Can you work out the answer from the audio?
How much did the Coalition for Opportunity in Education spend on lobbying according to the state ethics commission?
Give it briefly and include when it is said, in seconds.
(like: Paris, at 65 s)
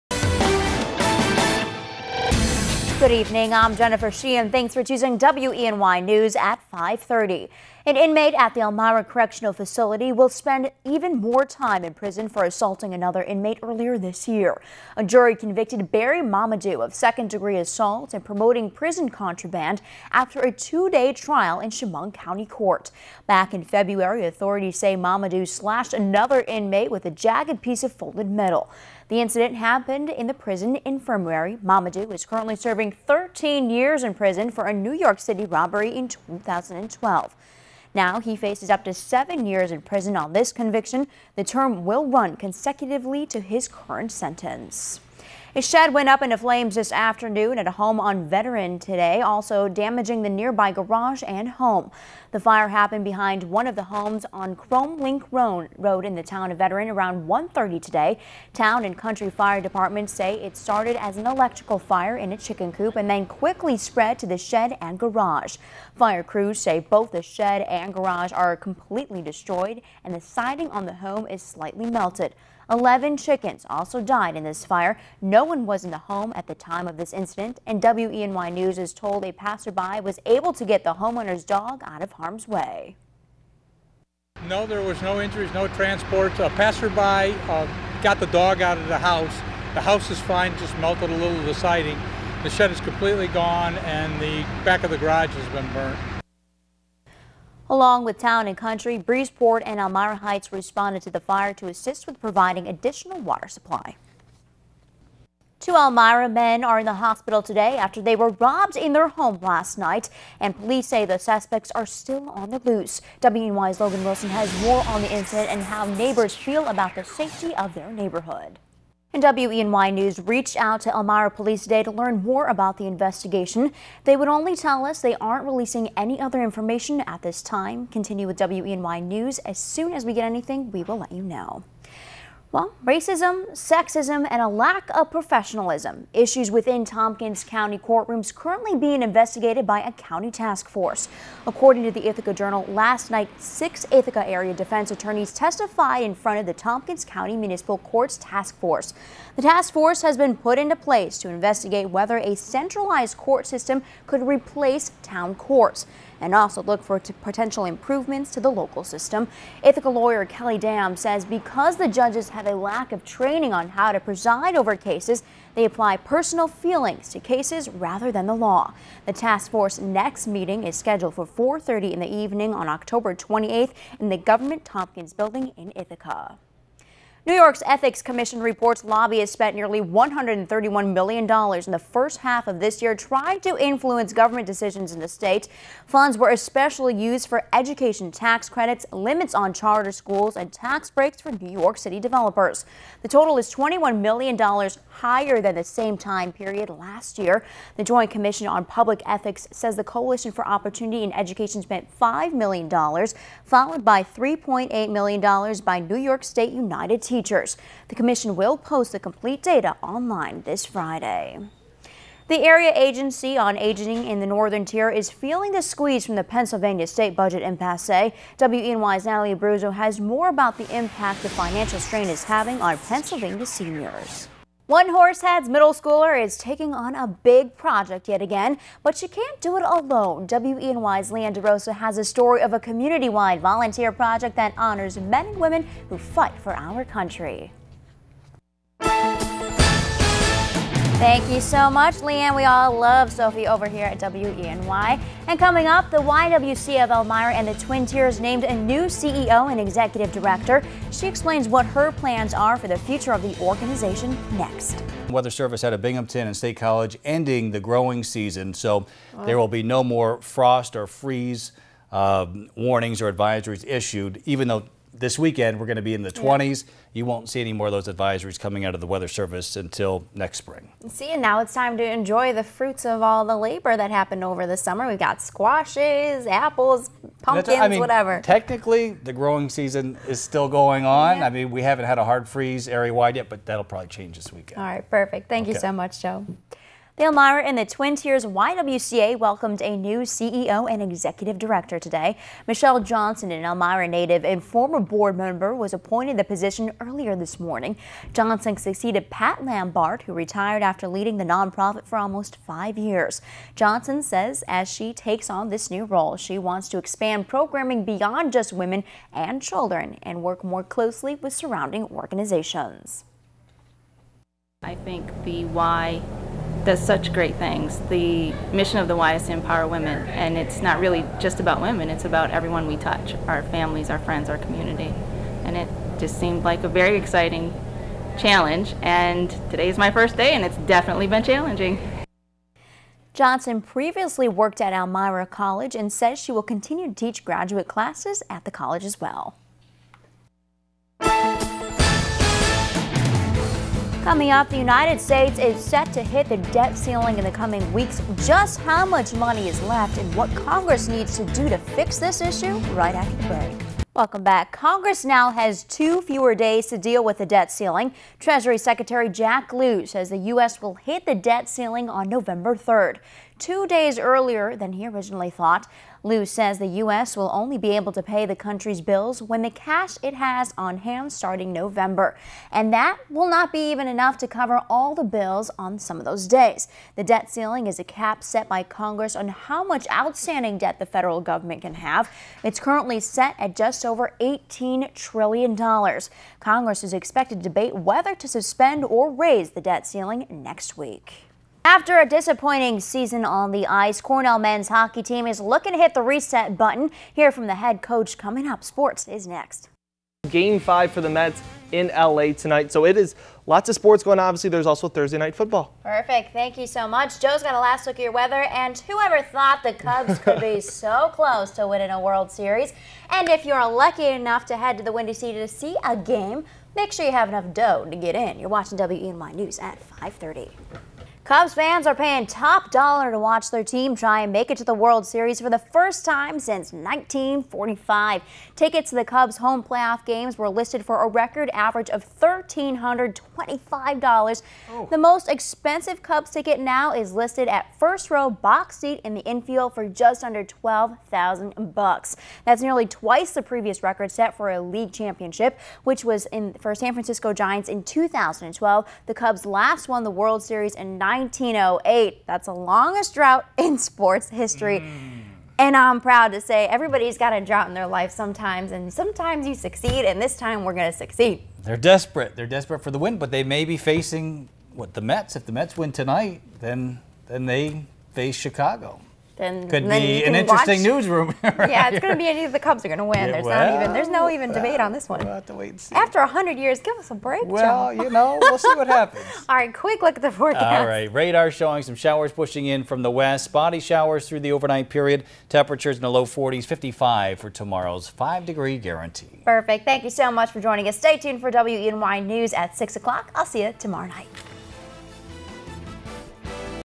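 $5 million, at 201 s.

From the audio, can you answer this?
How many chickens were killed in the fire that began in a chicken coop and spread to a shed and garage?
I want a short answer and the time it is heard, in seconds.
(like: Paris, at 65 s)
11, at 72 s.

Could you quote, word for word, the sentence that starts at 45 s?
A shed went up into flames this afternoon at a home on Veteran today, also damaging the nearby garage and home.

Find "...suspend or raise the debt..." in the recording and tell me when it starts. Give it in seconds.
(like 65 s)
388 s.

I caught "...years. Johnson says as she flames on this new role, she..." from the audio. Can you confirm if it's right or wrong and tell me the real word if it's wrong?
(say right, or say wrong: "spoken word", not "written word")
wrong: "takes", not "flames".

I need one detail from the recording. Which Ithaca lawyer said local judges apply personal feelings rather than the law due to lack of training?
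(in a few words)
Kelly Dam.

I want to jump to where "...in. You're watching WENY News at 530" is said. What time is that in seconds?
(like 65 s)
418 s.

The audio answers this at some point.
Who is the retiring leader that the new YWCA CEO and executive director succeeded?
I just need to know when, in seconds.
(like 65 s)
299 s.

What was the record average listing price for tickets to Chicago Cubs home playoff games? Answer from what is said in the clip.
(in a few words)
$1,325.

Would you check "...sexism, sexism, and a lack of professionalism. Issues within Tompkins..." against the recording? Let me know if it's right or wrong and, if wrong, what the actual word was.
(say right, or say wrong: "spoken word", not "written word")
wrong: "racism", not "sexism".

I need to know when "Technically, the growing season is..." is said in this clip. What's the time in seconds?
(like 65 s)
278 s.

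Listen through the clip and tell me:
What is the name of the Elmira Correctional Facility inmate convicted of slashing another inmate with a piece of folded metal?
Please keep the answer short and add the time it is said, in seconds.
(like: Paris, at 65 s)
Barry Mamadou, at 15 s.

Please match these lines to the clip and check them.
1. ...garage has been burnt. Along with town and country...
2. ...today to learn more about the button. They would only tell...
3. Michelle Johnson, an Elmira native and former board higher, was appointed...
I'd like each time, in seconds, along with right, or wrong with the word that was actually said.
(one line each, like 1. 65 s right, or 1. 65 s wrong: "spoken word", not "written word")
1. 94 s right
2. 121 s wrong: "investigation", not "button"
3. 292 s wrong: "member", not "higher".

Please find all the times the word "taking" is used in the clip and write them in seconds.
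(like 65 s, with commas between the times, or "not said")
226 s.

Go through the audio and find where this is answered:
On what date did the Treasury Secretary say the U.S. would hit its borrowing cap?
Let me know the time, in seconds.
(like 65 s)
362 s.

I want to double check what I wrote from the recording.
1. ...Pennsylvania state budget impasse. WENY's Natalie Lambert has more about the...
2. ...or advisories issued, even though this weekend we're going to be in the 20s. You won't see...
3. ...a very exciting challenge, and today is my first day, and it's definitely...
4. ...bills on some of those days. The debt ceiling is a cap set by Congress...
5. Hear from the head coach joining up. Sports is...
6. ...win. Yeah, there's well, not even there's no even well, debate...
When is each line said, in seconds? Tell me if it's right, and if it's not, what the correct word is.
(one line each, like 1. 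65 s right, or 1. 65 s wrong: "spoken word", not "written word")
1. 216 s wrong: "Abruzzo", not "Lambert"
2. 263 s right
3. 326 s right
4. 375 s right
5. 397 s wrong: "coming", not "joining"
6. 473 s right.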